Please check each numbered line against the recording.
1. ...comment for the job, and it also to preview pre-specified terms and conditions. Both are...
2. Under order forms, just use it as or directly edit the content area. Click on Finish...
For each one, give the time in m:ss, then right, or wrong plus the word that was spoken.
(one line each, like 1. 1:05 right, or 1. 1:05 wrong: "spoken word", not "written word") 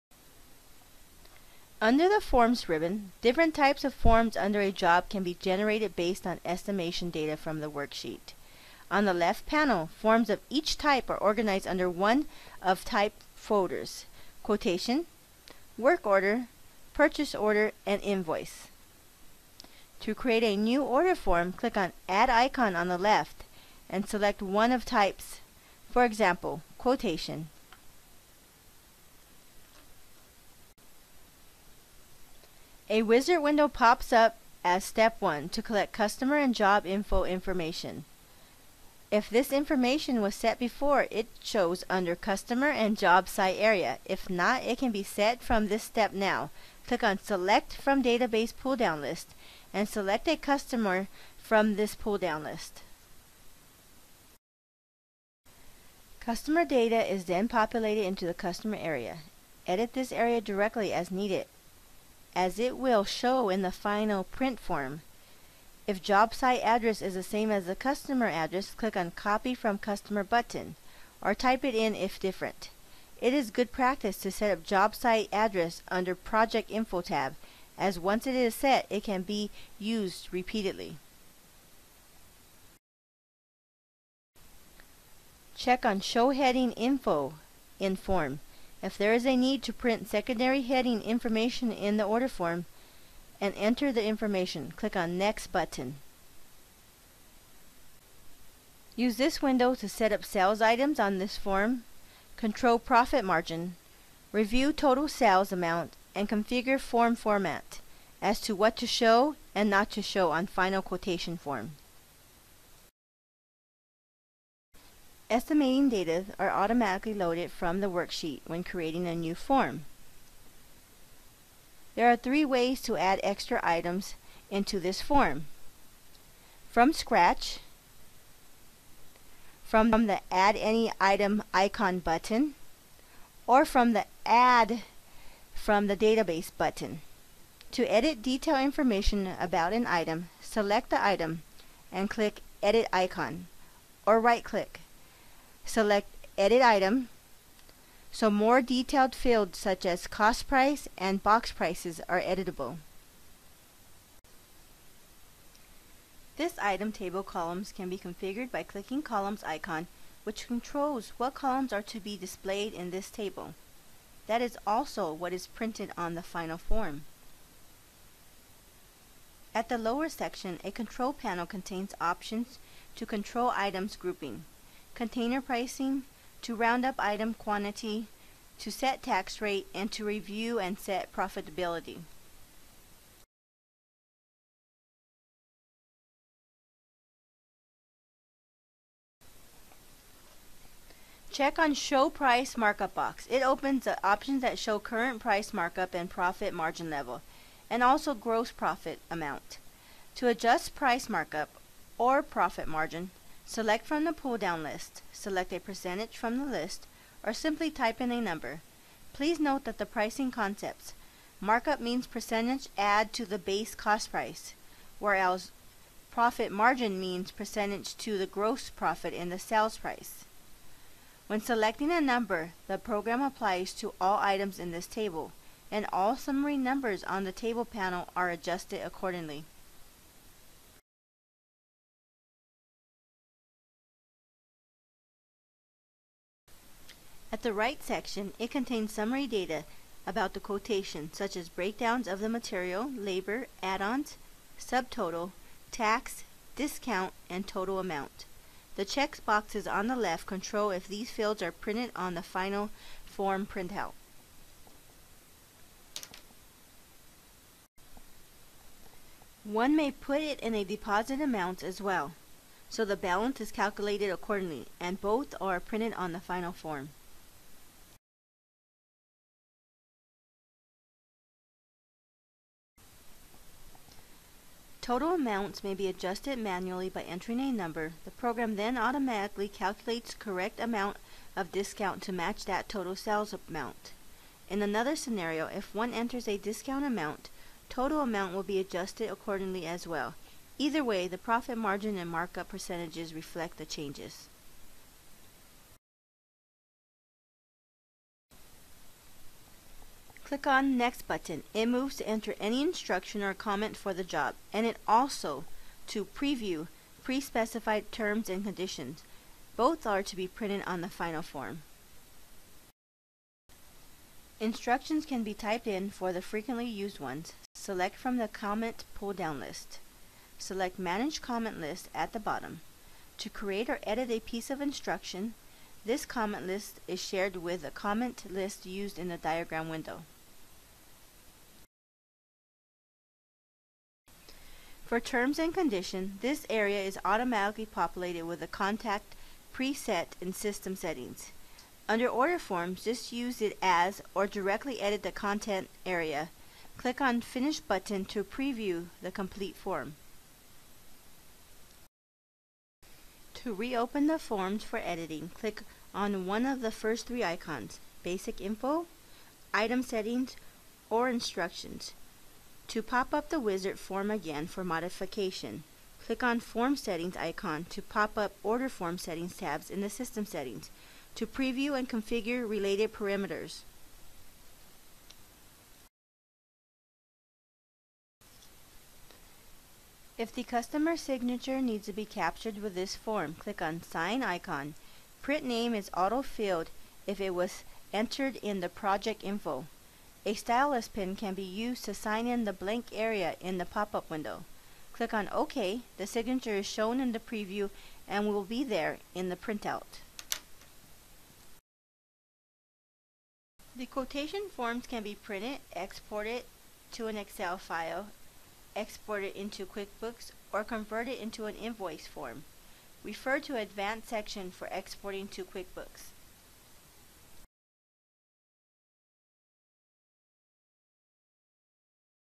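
1. 5:03 right
2. 5:41 right.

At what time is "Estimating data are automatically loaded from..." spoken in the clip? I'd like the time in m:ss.
1:55.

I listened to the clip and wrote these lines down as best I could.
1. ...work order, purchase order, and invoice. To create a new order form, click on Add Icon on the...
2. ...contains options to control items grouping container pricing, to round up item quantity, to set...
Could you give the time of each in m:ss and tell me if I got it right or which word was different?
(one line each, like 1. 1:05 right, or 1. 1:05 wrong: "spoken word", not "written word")
1. 0:15 right
2. 2:51 right.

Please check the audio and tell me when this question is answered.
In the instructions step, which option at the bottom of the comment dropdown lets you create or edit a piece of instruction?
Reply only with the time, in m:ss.
5:20.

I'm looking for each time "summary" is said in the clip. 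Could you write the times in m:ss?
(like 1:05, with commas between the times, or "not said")
3:46, 3:58.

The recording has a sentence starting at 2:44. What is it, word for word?
That is also what is printed on the final form.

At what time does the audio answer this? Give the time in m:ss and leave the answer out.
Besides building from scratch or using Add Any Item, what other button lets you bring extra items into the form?
2:14.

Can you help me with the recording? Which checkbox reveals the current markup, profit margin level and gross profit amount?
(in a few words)
Show Price Markup.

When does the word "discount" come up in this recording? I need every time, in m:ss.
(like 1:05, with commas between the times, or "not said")
4:06, 4:41, 4:46.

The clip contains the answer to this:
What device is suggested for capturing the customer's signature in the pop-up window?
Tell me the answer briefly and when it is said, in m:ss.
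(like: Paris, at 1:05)
stylus pen, at 6:30.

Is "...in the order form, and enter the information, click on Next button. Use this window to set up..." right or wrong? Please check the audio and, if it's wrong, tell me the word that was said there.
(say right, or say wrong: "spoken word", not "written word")
right.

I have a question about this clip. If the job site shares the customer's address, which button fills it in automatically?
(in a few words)
copy from customer.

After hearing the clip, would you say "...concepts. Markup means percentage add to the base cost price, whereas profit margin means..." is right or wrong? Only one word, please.
right.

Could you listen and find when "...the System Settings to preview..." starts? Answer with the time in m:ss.
6:09.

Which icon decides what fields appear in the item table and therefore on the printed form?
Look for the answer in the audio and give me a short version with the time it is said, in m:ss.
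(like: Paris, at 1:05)
columns icon, at 2:39.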